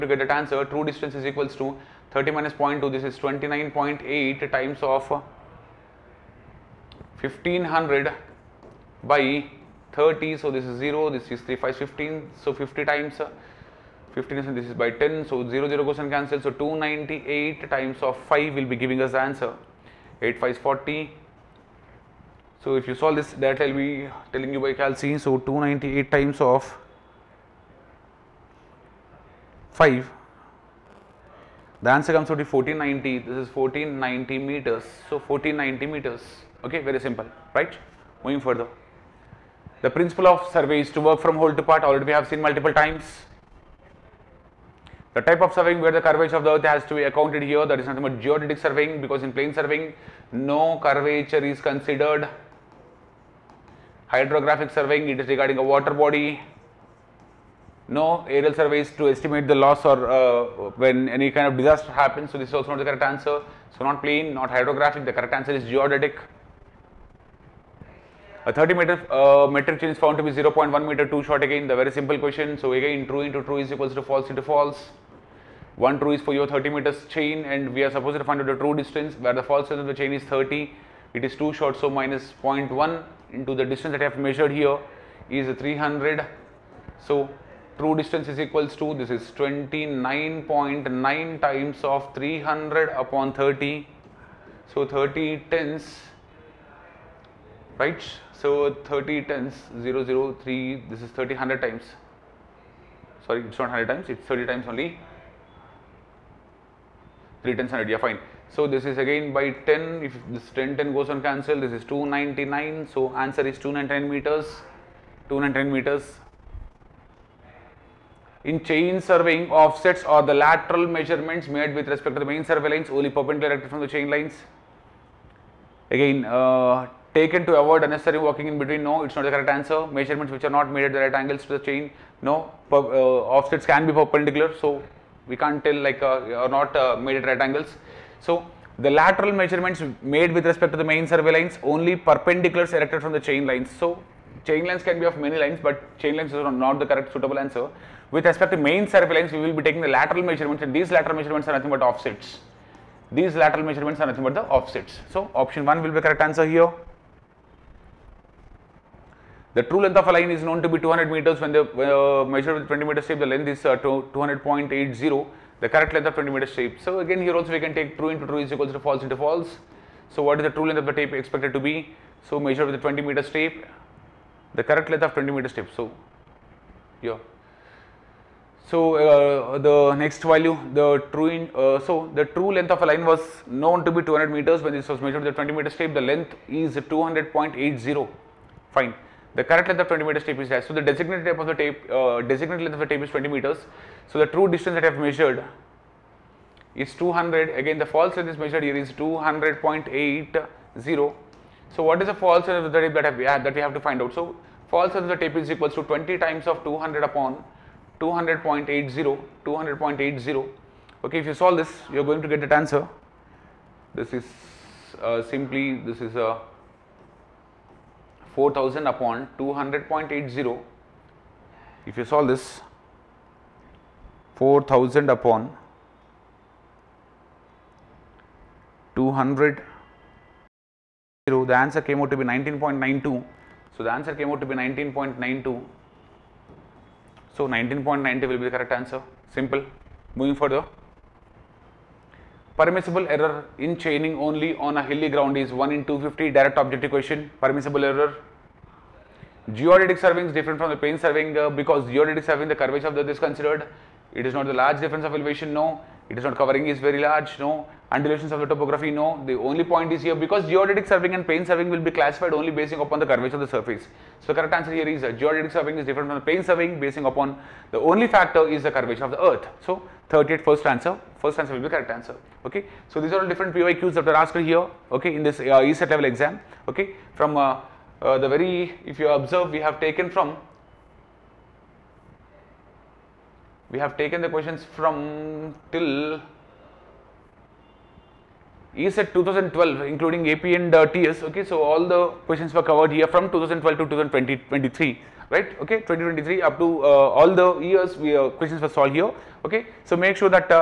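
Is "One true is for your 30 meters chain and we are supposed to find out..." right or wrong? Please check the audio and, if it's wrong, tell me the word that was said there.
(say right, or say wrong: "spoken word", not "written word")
right.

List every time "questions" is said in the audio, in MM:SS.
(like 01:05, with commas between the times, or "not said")
01:12, 04:44, 04:52, 04:58.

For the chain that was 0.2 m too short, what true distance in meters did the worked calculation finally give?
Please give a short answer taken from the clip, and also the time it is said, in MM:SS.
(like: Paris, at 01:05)
1490, at 00:31.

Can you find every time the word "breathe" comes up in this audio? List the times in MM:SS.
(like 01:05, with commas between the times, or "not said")
not said.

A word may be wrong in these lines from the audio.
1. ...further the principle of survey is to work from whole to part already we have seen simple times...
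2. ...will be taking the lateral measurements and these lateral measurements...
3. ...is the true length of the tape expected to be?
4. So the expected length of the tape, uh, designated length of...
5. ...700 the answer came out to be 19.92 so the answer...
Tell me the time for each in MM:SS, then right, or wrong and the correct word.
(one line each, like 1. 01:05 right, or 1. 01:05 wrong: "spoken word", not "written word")
1. 00:38 wrong: "multiple", not "simple"
2. 02:29 right
3. 02:50 right
4. 03:10 wrong: "designated", not "expected"
5. 03:48 wrong: "200", not "700".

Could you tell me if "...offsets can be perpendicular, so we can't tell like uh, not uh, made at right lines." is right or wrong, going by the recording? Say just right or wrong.
wrong.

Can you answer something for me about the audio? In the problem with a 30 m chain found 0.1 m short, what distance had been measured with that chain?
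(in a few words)
300.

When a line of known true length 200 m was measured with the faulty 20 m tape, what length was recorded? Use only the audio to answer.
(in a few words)
200.80.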